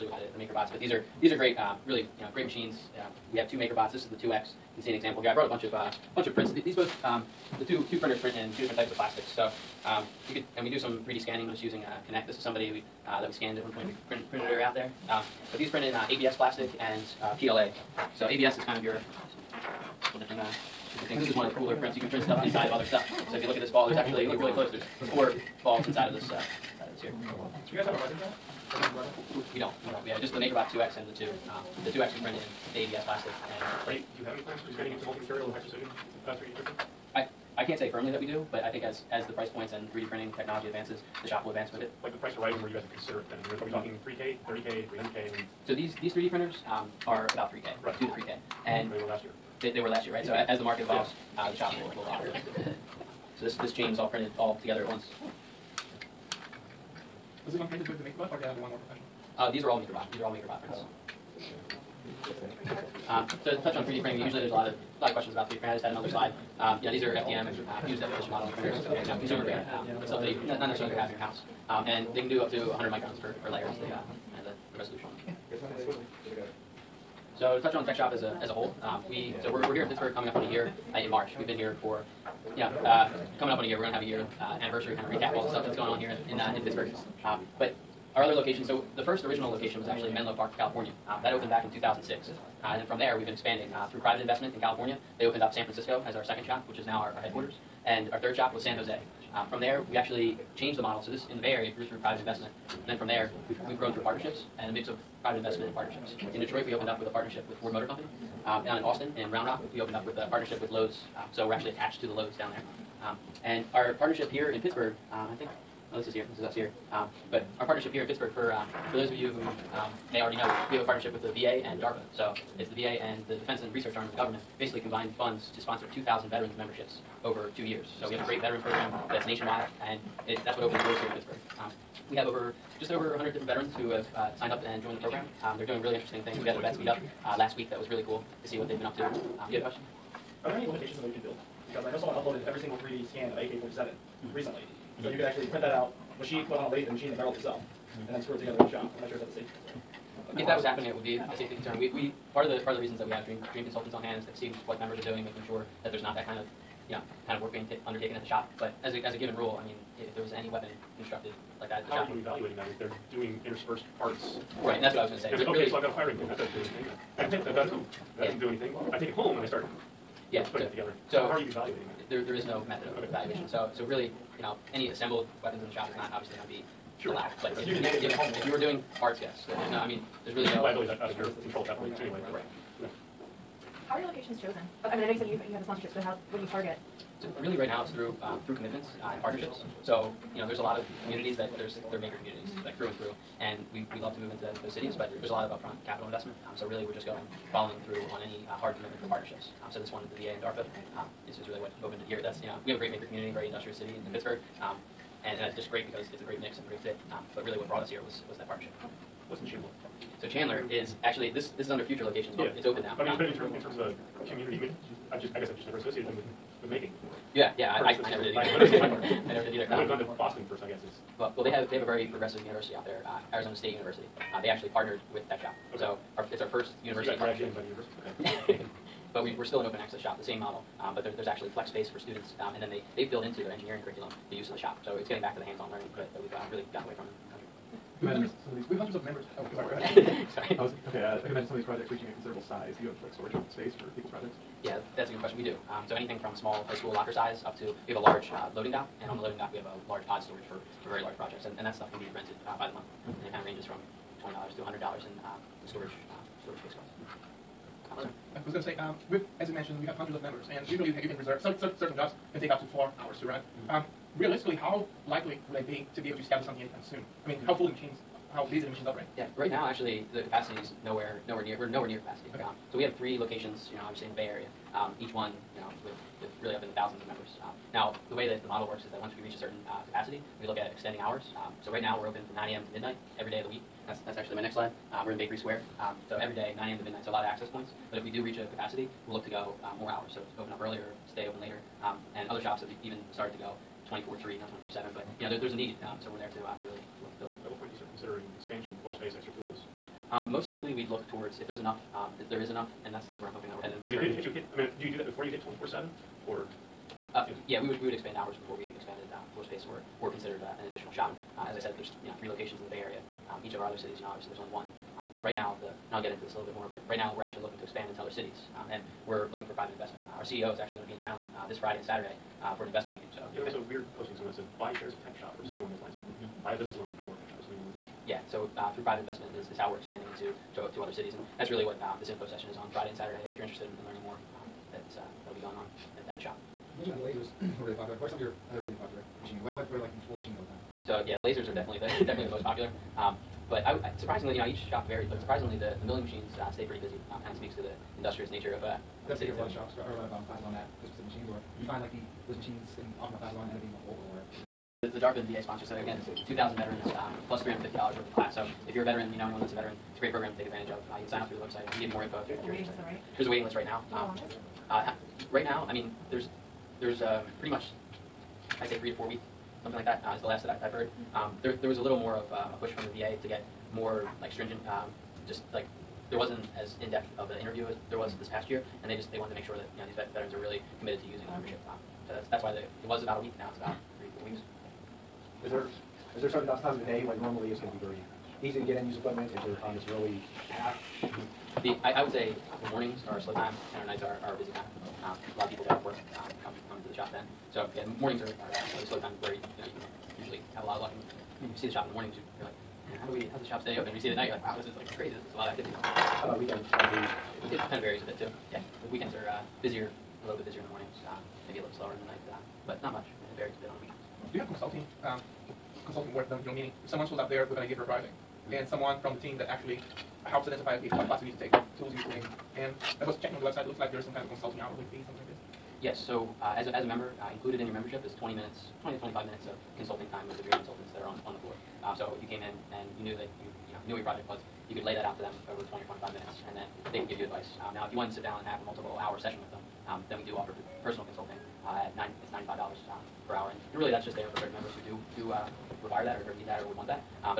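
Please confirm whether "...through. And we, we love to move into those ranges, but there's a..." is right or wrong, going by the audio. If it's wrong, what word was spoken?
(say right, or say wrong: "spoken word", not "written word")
wrong: "cities", not "ranges".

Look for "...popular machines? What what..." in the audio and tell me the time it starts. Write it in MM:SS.
05:38.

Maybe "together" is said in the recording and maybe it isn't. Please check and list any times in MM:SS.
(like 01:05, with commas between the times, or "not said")
00:54, 02:28, 02:50.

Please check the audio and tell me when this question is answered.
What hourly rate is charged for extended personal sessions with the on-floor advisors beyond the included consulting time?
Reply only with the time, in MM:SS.
07:22.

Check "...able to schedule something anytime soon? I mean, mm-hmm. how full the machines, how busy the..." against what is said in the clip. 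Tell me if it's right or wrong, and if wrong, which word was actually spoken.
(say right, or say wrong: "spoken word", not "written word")
right.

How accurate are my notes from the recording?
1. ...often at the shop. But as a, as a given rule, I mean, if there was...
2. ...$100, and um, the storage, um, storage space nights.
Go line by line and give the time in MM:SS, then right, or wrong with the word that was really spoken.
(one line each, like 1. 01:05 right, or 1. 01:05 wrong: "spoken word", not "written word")
1. 02:37 wrong: "undertaken", not "often"
2. 04:14 wrong: "costs", not "nights".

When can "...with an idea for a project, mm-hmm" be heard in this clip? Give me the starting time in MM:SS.
06:57.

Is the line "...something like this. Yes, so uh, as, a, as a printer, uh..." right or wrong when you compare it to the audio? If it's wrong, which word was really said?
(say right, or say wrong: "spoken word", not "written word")
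wrong: "member", not "printer".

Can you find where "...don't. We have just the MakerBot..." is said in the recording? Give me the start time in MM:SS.
00:29.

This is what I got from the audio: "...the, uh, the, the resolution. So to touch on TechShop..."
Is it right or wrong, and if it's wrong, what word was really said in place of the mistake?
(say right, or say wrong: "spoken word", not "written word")
right.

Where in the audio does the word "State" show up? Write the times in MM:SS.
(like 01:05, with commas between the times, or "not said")
03:43.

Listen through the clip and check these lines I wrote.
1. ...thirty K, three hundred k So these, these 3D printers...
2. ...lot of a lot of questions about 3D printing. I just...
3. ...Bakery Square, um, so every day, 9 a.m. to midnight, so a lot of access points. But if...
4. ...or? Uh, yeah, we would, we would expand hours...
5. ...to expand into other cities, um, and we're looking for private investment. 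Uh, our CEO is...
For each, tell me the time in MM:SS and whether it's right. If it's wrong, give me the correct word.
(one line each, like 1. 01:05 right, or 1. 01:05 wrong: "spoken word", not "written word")
1. 00:44 right
2. 01:04 right
3. 04:45 right
4. 05:06 right
5. 05:17 right.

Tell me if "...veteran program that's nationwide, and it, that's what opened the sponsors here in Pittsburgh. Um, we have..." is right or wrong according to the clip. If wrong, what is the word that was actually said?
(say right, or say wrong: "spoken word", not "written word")
wrong: "doors", not "sponsors".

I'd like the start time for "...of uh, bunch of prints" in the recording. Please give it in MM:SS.
00:05.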